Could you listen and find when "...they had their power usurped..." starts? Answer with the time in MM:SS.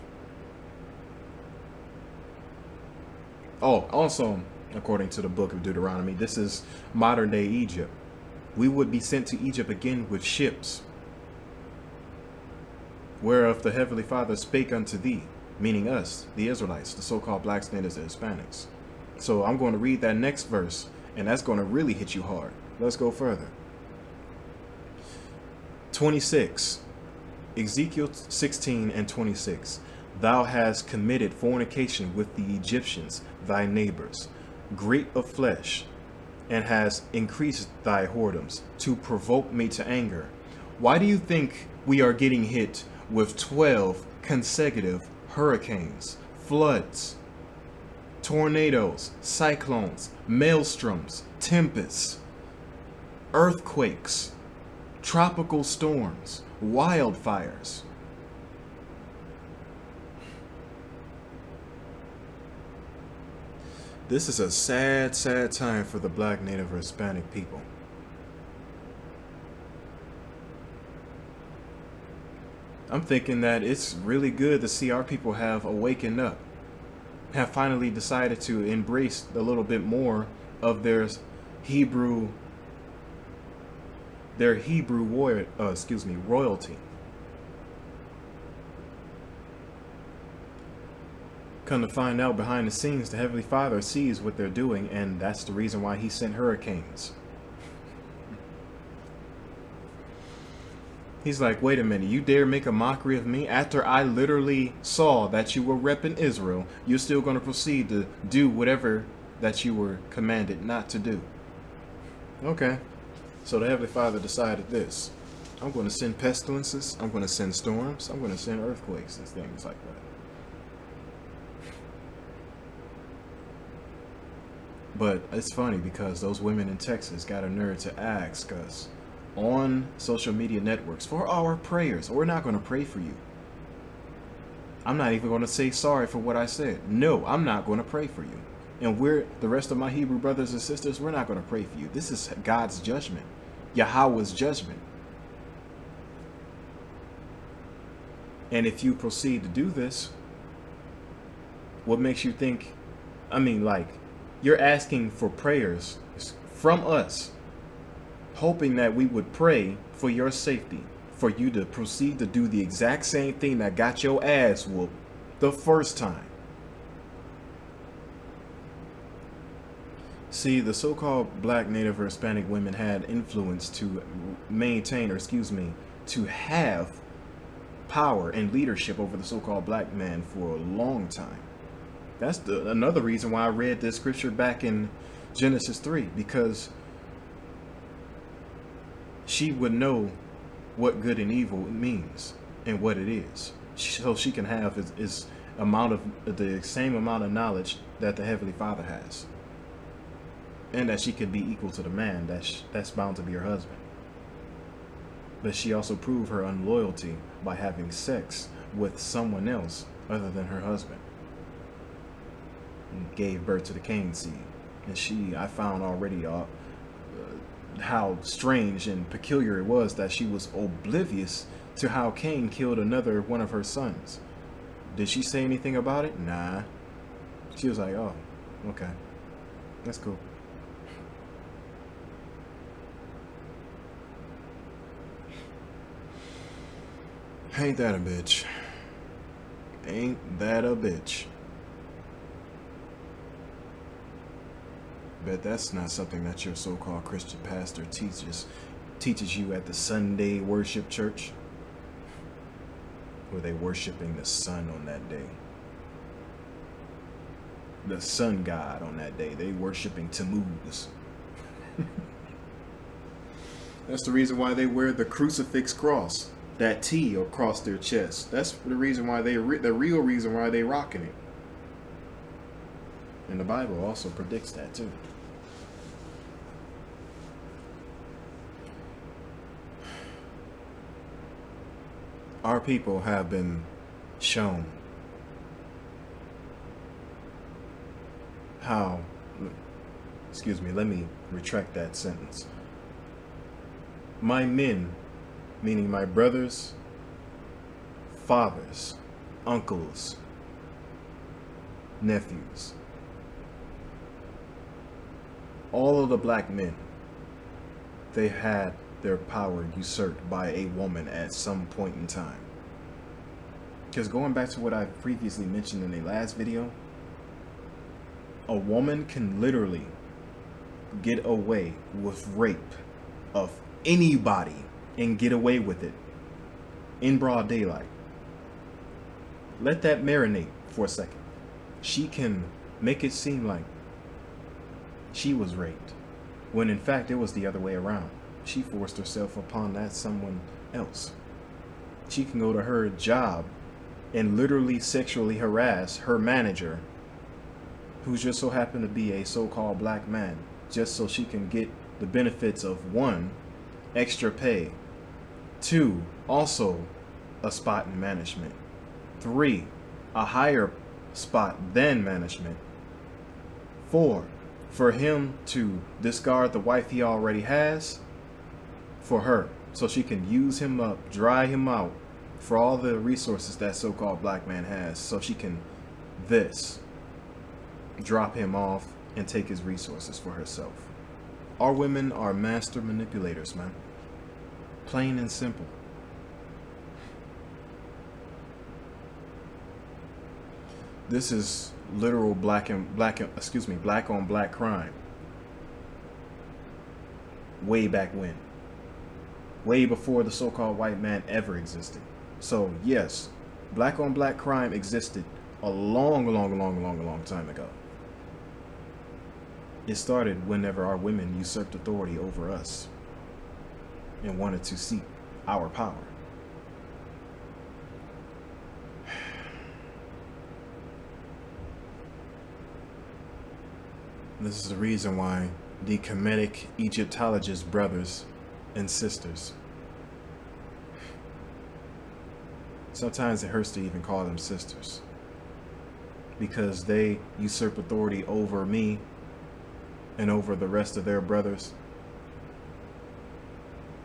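05:08.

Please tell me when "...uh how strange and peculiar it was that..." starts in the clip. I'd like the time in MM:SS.
03:36.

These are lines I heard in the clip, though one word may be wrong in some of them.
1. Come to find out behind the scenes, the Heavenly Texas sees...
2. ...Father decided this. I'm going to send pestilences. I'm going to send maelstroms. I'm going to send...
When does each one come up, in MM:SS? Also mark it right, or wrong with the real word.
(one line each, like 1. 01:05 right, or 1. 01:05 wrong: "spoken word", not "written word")
1. 01:31 wrong: "Father", not "Texas"
2. 01:53 wrong: "storms", not "maelstroms".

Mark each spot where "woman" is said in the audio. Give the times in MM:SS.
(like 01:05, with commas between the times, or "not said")
05:10, 05:18.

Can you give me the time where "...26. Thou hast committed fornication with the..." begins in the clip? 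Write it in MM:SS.
00:29.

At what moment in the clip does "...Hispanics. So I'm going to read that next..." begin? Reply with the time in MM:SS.
00:18.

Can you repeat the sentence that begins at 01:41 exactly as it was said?
He's like, wait a minute, you dare make a mockery of me?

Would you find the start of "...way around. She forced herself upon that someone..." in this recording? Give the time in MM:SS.
05:37.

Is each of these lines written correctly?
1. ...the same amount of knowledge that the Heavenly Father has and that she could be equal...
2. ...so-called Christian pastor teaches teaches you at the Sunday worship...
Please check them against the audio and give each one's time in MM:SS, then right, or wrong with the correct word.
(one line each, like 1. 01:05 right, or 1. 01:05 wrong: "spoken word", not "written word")
1. 03:16 right
2. 04:06 right.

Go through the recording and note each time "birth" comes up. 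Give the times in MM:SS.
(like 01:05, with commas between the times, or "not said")
03:33.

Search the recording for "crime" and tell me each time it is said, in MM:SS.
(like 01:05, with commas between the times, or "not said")
06:34, 06:44.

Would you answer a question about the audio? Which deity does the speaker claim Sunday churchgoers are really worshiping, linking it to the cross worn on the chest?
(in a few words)
Tammuz.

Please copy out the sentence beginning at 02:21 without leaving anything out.
This is God's judgment, Yahweh's judgment.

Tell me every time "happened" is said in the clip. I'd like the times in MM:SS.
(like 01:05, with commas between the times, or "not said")
05:48.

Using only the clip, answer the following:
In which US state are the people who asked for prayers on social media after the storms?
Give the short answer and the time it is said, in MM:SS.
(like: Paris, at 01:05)
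Texas, at 02:06.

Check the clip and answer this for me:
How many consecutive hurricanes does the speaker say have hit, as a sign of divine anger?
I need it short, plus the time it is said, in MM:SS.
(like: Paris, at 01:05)
12, at 00:43.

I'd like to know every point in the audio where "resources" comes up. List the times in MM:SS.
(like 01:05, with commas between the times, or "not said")
06:12, 06:19.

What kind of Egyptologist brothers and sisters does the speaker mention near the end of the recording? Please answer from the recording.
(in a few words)
Kemetic.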